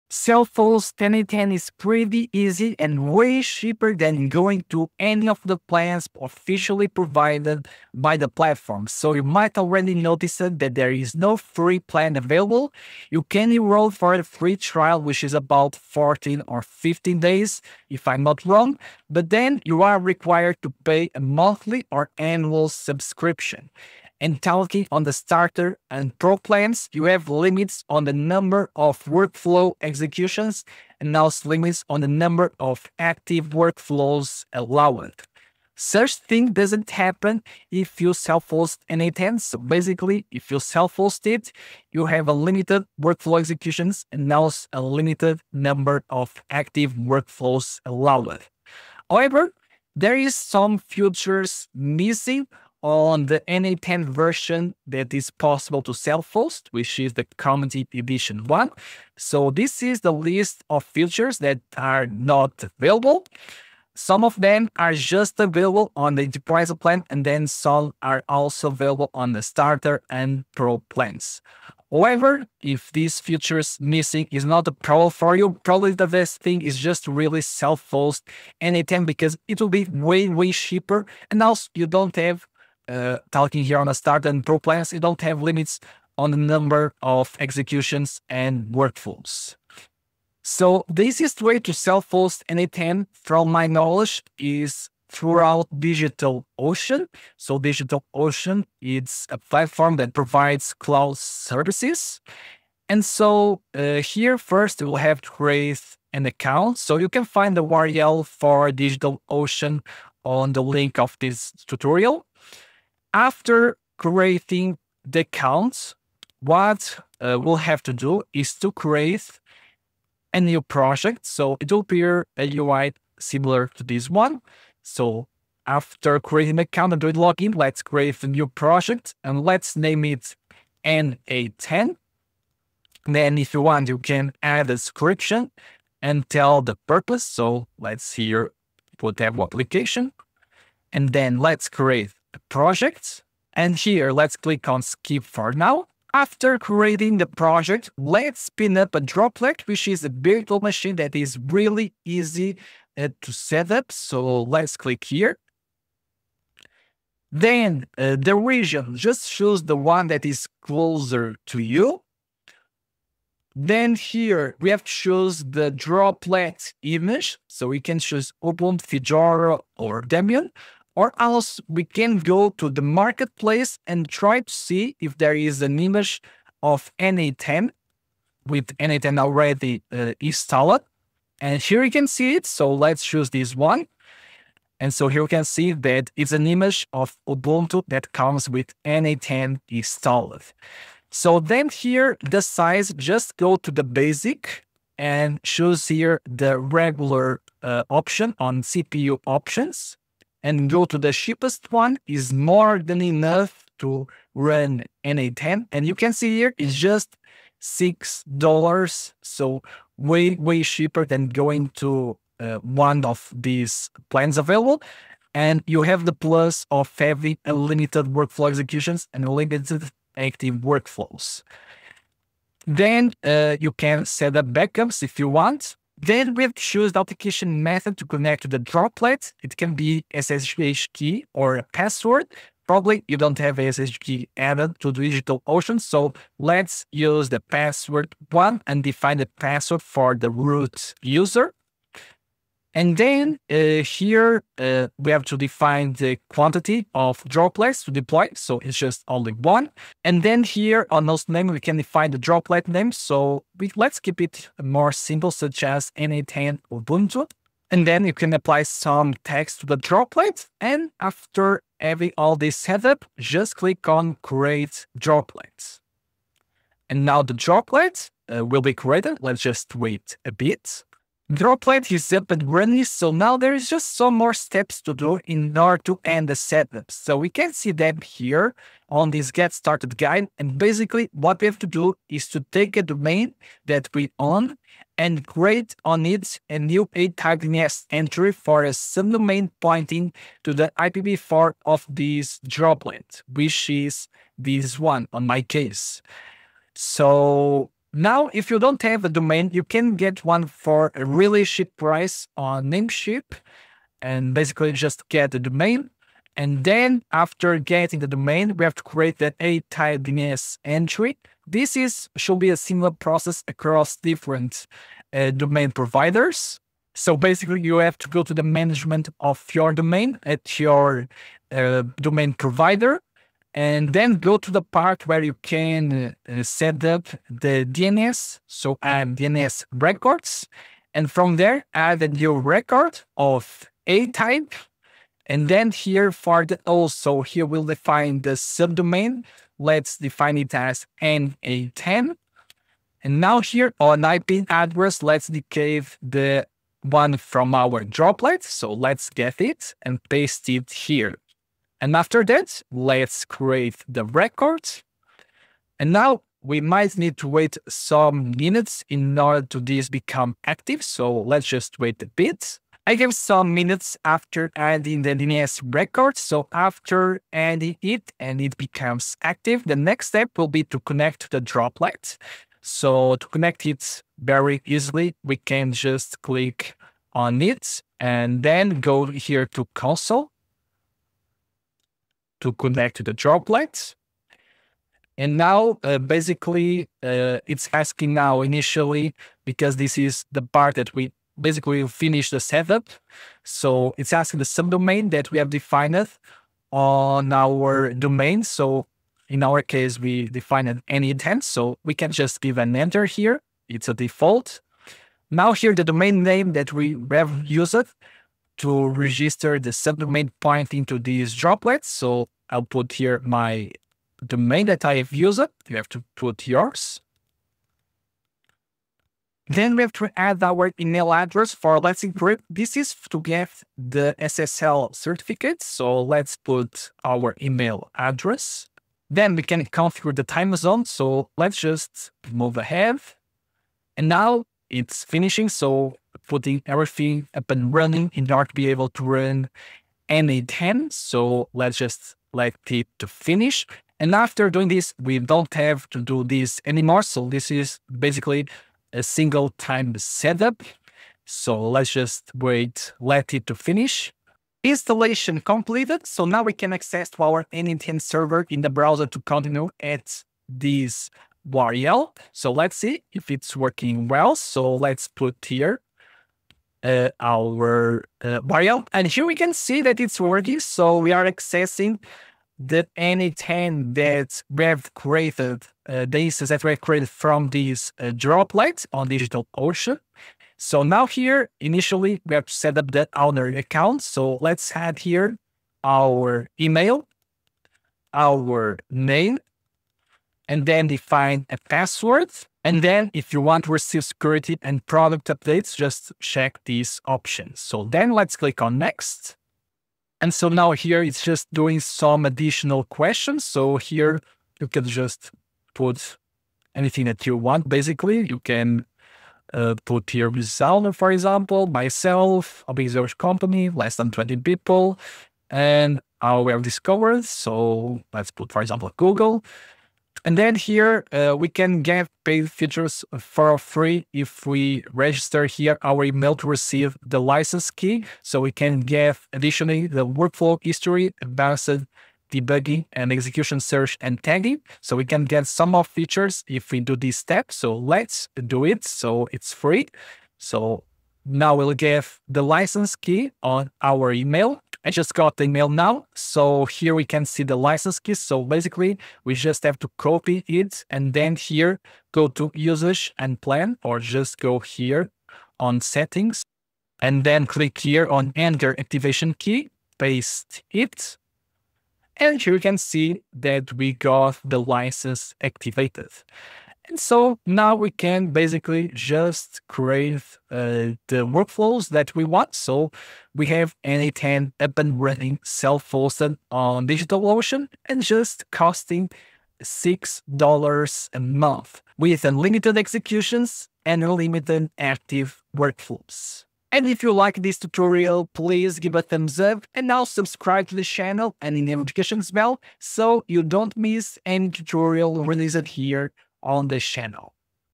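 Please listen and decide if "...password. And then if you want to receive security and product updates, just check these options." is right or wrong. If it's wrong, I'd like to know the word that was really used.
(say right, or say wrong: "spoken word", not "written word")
right.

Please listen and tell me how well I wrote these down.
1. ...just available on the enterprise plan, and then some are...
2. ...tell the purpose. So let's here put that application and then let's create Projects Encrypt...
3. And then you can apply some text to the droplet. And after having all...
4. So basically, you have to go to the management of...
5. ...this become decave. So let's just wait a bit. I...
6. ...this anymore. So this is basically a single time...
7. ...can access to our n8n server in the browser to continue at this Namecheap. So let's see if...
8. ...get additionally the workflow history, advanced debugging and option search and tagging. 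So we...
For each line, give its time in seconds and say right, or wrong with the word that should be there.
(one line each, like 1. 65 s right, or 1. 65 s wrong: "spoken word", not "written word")
1. 64 s right
2. 136 s wrong: "And", not "Encrypt"
3. 257 s right
4. 316 s right
5. 359 s wrong: "active", not "decave"
6. 446 s right
7. 456 s wrong: "URL", not "Namecheap"
8. 528 s wrong: "execution", not "option".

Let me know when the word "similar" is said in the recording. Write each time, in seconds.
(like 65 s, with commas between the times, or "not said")
123 s, 312 s.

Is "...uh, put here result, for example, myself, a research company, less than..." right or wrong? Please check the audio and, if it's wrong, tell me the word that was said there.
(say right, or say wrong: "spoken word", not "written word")
right.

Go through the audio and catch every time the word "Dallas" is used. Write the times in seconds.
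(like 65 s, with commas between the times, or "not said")
not said.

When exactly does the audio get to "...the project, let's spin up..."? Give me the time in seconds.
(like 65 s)
147 s.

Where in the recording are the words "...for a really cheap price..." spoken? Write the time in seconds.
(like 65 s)
300 s.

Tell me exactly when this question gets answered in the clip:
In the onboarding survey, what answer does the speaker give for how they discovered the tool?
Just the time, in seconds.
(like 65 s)
518 s.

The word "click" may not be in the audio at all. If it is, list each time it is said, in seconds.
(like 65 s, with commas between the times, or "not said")
144 s, 154 s, 263 s, 376 s, 498 s, 557 s.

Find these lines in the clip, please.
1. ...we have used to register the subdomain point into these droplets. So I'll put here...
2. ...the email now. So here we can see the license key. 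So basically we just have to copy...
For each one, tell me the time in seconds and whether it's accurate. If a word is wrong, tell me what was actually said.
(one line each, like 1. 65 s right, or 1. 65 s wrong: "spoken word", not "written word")
1. 406 s right
2. 545 s right.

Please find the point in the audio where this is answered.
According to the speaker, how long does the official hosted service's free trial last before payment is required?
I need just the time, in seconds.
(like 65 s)
15 s.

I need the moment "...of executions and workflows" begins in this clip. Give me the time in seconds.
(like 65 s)
87 s.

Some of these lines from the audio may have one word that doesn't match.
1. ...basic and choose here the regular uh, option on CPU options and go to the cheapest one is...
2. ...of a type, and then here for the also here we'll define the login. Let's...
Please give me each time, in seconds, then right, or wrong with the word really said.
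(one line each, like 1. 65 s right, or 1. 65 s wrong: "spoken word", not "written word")
1. 193 s right
2. 333 s wrong: "subdomain", not "login".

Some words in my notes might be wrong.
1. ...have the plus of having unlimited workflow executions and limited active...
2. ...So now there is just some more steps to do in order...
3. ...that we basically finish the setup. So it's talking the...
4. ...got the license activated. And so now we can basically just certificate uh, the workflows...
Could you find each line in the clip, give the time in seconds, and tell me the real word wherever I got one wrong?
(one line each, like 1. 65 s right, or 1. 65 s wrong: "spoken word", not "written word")
1. 215 s right
2. 272 s right
3. 390 s wrong: "asking", not "talking"
4. 563 s wrong: "create", not "certificate".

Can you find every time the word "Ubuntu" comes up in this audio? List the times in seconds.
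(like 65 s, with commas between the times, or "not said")
168 s, 187 s, 256 s.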